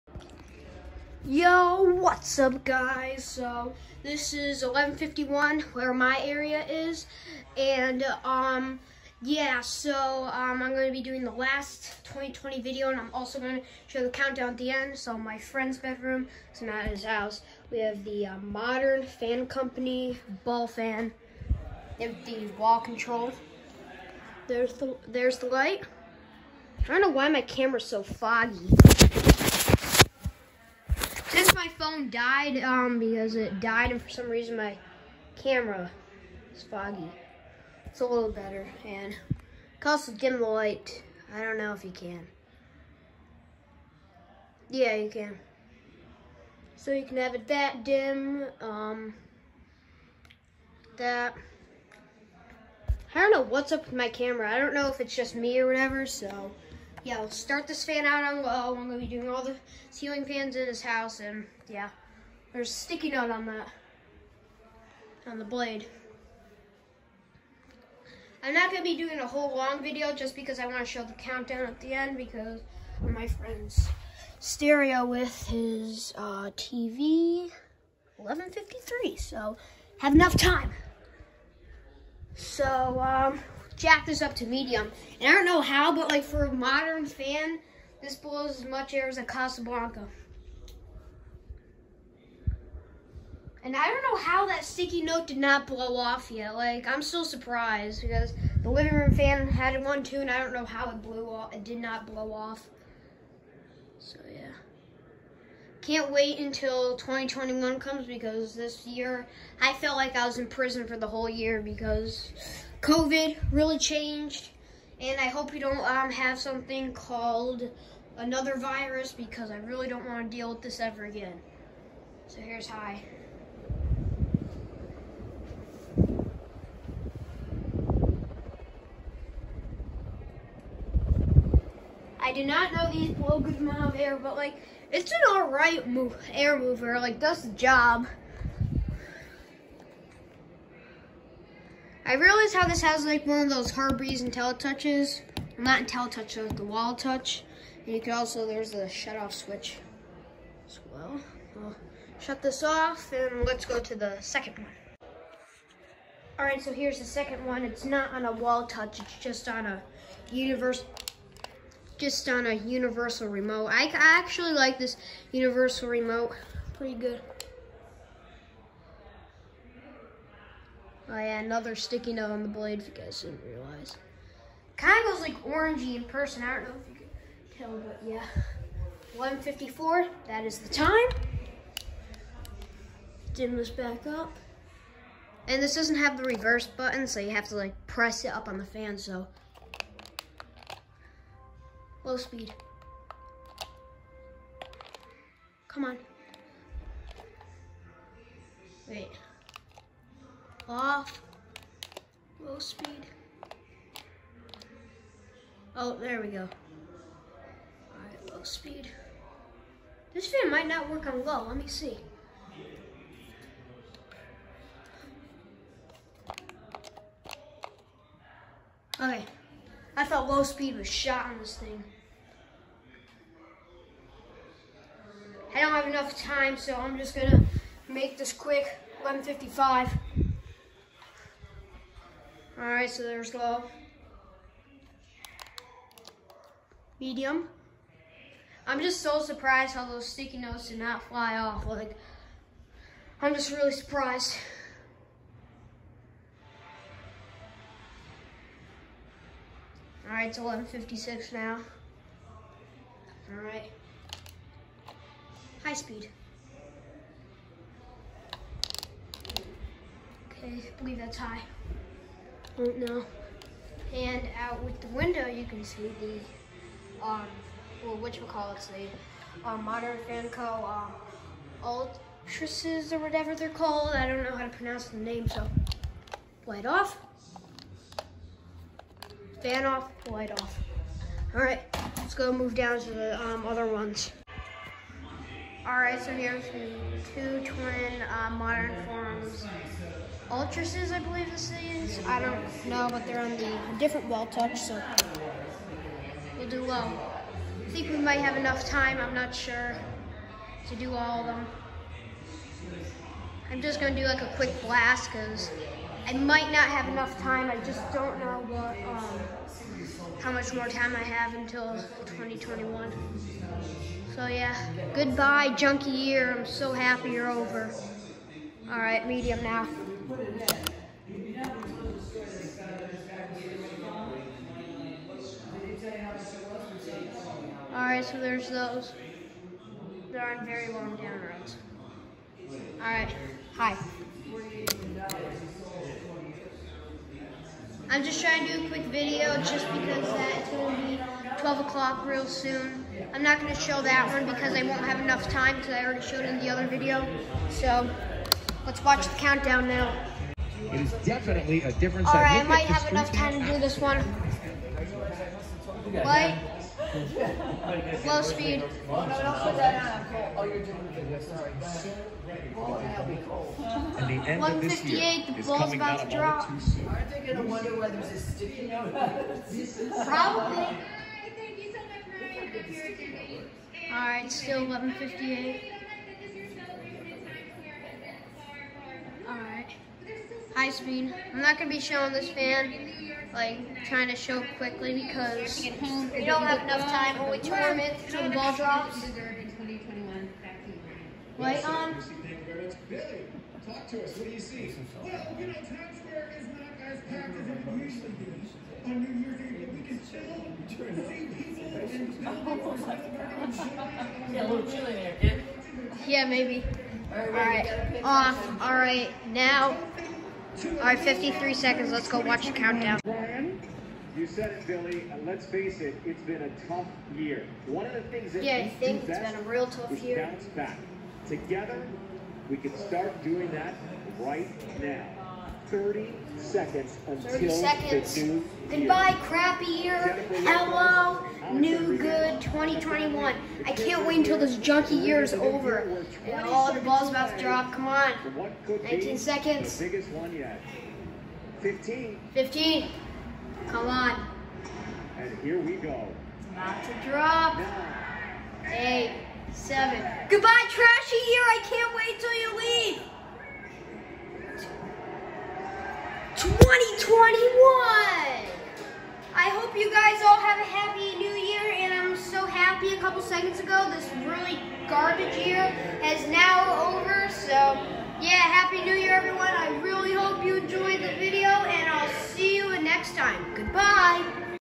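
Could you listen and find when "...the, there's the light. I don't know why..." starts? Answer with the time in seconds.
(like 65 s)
24 s.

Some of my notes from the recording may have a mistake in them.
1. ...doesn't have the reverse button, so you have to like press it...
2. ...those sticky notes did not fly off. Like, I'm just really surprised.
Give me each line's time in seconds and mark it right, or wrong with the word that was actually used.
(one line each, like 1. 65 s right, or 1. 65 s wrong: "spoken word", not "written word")
1. 185 s right
2. 239 s right.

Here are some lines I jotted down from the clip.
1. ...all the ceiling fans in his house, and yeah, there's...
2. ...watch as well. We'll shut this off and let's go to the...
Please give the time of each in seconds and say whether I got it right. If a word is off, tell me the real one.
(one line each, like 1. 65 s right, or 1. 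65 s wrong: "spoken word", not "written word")
1. 59 s right
2. 149 s wrong: "switch", not "watch".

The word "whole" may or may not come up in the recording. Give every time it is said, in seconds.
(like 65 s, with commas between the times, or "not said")
69 s, 111 s.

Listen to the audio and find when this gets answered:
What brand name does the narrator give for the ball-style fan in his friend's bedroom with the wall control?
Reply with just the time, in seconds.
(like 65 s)
18 s.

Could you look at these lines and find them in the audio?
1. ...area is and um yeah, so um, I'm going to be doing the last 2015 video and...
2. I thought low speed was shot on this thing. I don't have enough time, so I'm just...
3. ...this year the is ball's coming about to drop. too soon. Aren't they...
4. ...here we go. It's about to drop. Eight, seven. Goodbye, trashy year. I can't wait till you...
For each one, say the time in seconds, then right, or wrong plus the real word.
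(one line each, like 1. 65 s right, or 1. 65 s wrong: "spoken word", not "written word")
1. 6 s wrong: "2020", not "2015"
2. 219 s right
3. 364 s right
4. 445 s right.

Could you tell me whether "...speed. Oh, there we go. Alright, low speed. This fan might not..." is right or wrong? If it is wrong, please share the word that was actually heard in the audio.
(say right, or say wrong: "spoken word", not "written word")
right.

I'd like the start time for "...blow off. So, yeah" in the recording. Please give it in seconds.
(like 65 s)
102 s.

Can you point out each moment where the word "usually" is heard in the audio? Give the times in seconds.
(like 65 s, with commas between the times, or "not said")
397 s.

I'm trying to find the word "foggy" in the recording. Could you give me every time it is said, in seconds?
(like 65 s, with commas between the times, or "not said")
28 s, 36 s.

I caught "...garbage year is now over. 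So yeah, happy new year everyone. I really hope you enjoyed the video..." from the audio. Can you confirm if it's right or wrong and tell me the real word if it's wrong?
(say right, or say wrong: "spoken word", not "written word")
right.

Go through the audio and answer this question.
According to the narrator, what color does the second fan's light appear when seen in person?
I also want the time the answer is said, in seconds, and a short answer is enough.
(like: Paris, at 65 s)
Orangey, at 175 s.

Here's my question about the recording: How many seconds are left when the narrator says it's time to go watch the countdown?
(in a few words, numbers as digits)
53.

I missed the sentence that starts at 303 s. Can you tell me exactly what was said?
I'm just going to do like a quick blast, because I might not have enough time.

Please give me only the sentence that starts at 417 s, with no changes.
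One of the things that yeah, I think it's been a real tough year.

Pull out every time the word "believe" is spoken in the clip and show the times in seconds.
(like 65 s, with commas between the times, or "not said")
260 s, 290 s.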